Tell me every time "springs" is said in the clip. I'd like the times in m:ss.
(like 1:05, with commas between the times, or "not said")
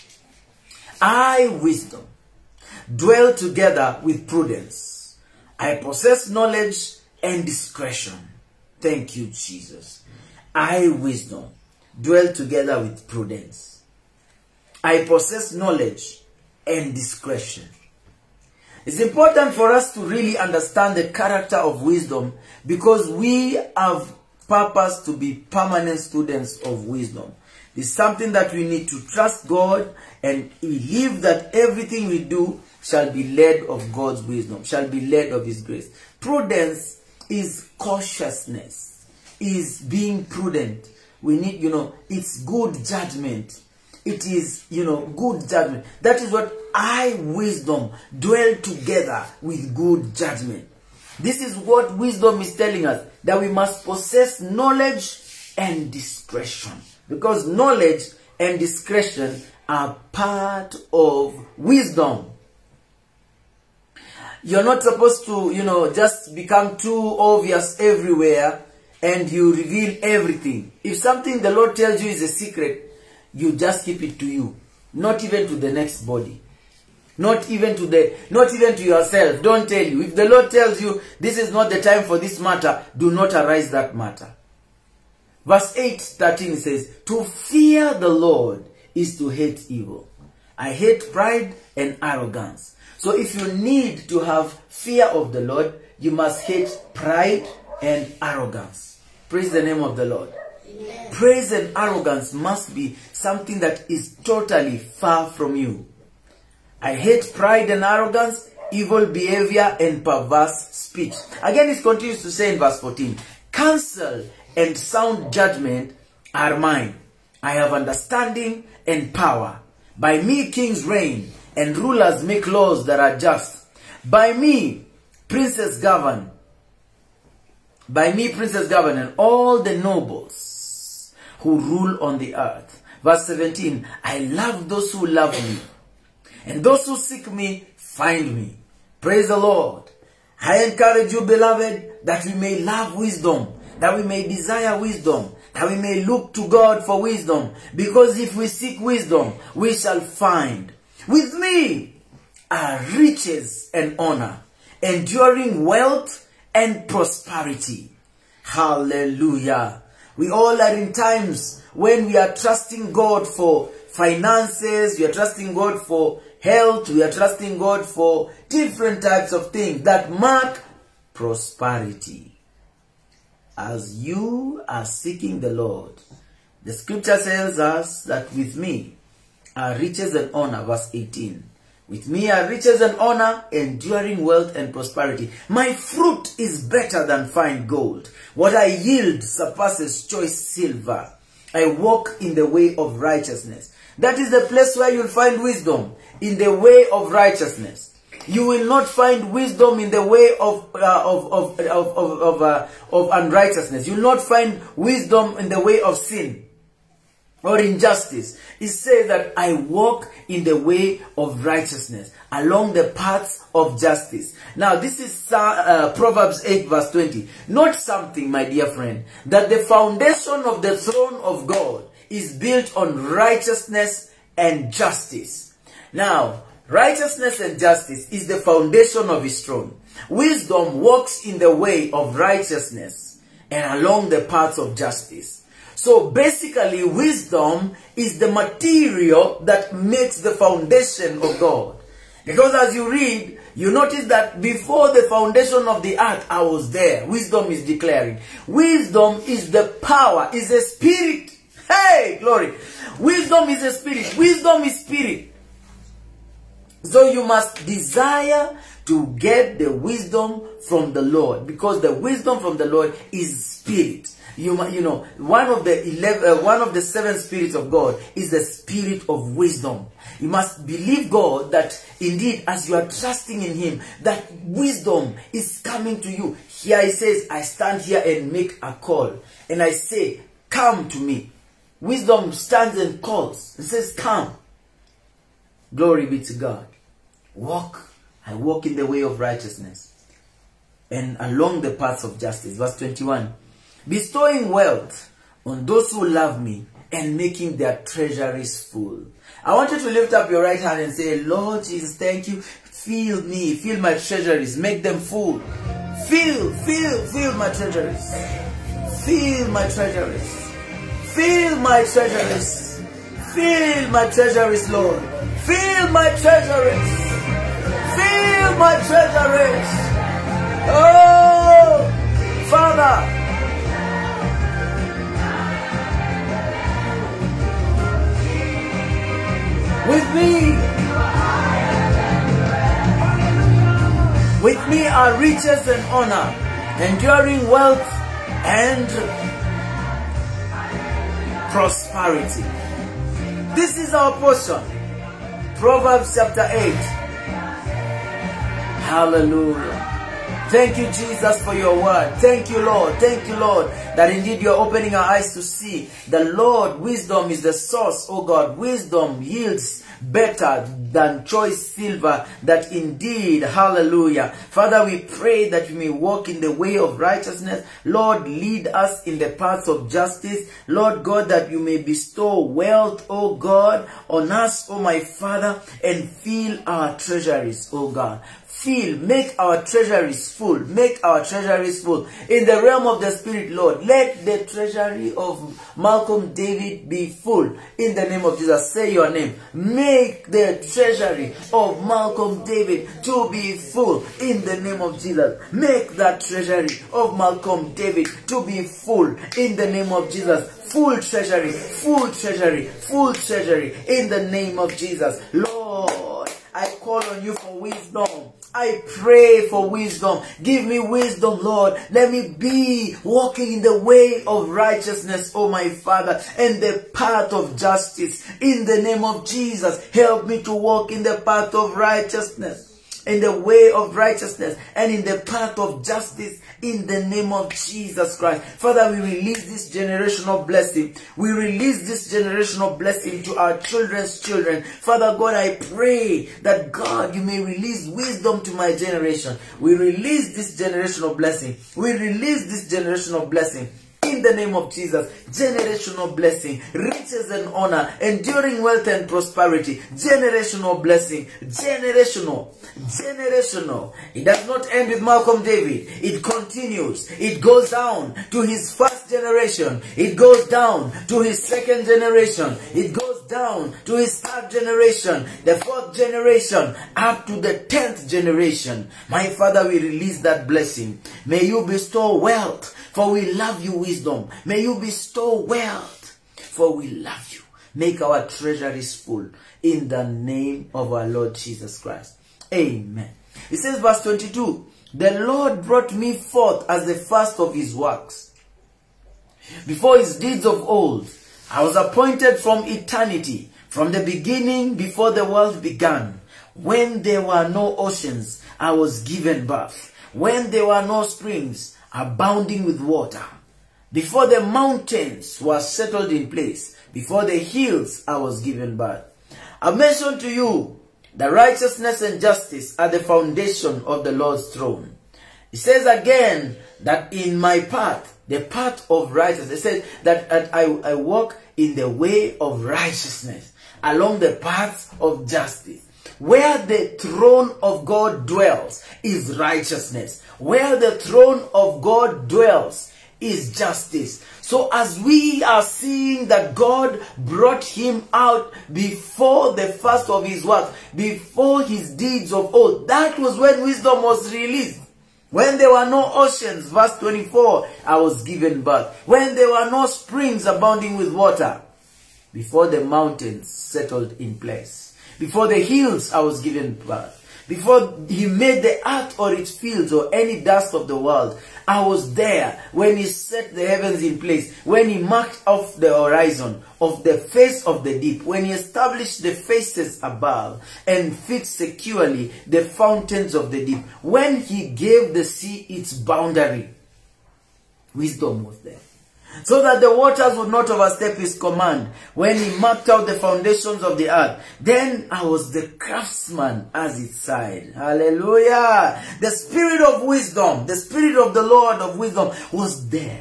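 8:21, 9:09.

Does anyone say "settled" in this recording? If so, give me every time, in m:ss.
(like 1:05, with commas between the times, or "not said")
8:25, 9:13.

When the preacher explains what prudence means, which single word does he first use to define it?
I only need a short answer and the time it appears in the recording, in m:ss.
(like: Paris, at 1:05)
Cautiousness, at 0:37.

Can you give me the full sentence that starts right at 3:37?
Not something, my dear friend, that the foundation of the throne of God is built on righteousness and justice.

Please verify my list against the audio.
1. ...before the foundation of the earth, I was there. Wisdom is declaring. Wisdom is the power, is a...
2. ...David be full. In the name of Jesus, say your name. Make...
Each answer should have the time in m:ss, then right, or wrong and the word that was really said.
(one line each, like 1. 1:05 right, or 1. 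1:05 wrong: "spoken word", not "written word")
1. 4:04 right
2. 6:26 right.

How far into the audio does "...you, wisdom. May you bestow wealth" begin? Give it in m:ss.
7:53.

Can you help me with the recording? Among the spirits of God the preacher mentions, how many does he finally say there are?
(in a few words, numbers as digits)
7.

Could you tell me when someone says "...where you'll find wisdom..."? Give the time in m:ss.
3:14.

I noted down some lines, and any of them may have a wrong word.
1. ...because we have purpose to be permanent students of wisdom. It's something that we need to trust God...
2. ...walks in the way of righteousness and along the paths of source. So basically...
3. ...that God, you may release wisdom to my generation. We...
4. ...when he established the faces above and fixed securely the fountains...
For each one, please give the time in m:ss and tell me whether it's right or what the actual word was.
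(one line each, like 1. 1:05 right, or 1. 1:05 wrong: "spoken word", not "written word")
1. 0:22 right
2. 3:50 wrong: "justice", not "source"
3. 7:16 right
4. 9:28 right.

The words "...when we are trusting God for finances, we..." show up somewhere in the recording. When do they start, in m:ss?
2:41.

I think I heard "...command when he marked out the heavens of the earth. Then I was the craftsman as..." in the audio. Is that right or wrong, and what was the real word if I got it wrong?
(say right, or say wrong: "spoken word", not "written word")
wrong: "foundations", not "heavens".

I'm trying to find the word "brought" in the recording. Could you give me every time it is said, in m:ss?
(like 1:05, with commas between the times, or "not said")
8:05, 8:57.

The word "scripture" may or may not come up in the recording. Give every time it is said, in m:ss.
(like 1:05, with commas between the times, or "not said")
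2:56.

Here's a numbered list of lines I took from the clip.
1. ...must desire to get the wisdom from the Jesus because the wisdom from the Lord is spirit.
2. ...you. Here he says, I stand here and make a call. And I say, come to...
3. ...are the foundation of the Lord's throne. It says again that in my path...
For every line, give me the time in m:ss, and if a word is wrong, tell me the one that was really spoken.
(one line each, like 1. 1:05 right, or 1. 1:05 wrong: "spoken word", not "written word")
1. 4:17 wrong: "Lord", not "Jesus"
2. 4:36 right
3. 8:32 right.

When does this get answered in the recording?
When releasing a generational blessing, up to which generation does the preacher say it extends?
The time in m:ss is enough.
7:47.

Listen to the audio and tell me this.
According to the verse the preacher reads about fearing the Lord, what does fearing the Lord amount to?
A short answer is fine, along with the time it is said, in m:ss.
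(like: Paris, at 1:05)
To hate evil, at 1:29.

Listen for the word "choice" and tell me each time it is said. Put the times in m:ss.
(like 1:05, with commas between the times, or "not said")
3:10, 6:01.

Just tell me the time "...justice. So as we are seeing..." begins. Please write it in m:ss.
8:53.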